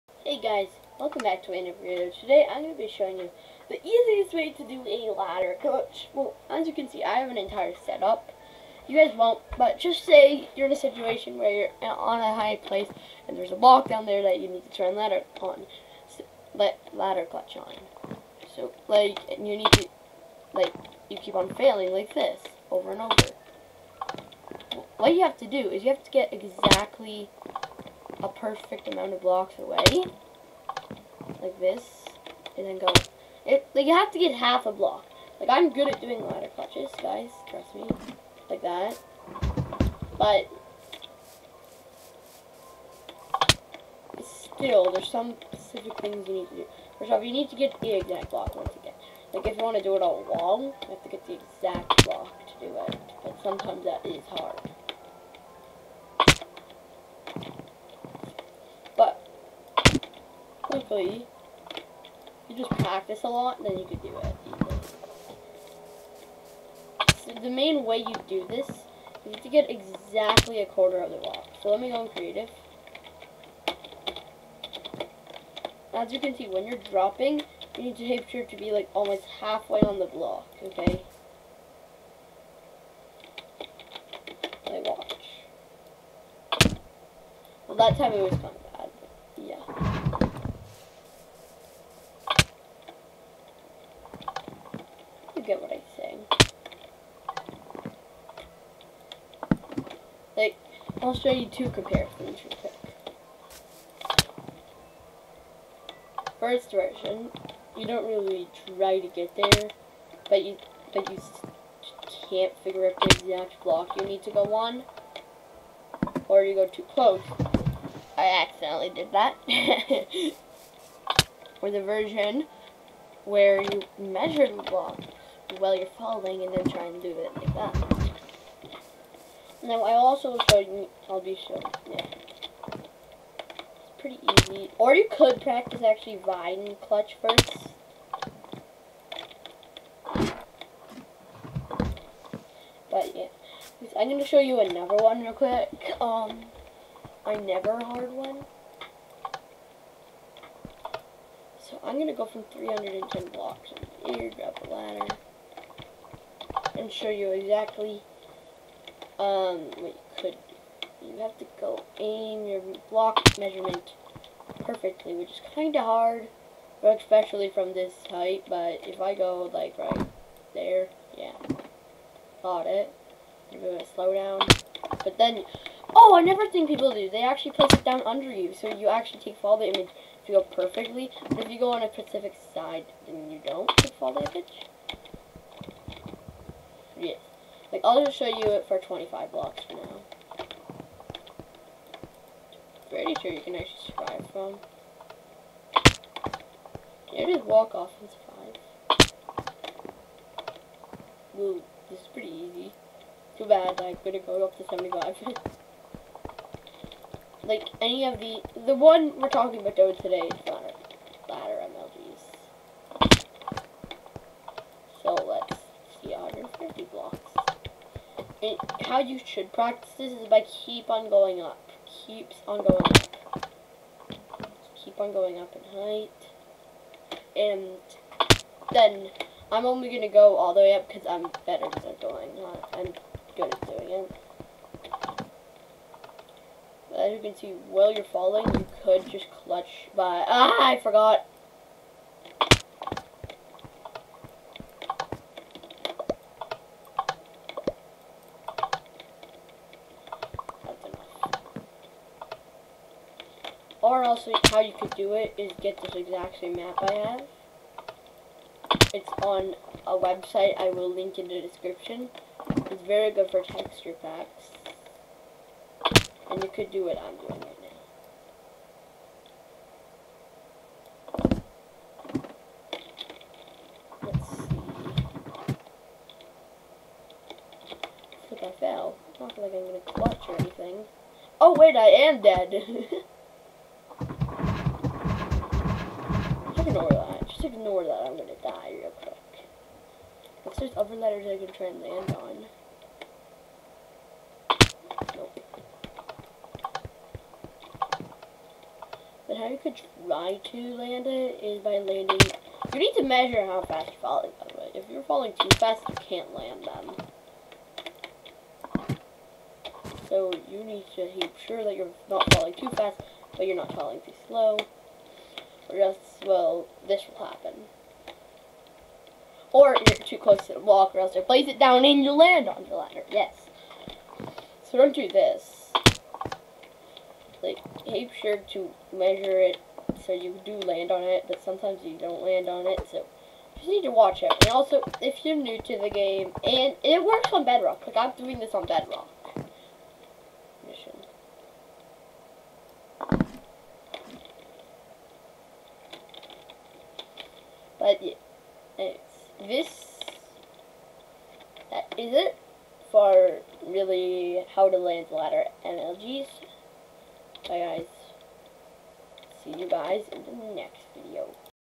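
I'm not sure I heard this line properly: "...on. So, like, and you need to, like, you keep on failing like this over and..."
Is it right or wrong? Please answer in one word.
right.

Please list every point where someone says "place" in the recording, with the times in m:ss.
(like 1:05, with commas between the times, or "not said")
0:12, 2:57, 5:21.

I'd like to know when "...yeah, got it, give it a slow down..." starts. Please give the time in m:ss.
2:51.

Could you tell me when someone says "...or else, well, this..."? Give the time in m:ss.
5:15.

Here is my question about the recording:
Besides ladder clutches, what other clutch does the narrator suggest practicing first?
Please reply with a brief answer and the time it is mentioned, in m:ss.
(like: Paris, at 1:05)
Vine clutch, at 2:16.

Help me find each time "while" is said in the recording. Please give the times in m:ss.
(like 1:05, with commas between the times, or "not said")
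2:05, 3:57.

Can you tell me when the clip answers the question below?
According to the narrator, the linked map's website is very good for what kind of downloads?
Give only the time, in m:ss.
4:23.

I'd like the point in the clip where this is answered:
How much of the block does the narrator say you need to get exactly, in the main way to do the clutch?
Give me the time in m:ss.
1:10.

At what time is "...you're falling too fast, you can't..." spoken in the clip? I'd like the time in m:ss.
5:04.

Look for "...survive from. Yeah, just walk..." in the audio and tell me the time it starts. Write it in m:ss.
3:13.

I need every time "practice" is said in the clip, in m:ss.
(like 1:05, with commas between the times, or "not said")
1:02, 2:15, 3:39.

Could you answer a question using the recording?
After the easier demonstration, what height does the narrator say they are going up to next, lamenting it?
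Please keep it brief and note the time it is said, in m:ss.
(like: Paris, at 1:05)
75, at 3:24.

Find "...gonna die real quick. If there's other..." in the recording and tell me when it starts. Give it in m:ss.
4:48.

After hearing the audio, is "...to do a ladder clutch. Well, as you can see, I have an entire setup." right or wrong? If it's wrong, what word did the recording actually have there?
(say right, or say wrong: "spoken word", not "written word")
right.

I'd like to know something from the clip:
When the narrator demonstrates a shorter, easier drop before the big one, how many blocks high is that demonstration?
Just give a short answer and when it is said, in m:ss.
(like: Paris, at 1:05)
25 blocks, at 3:08.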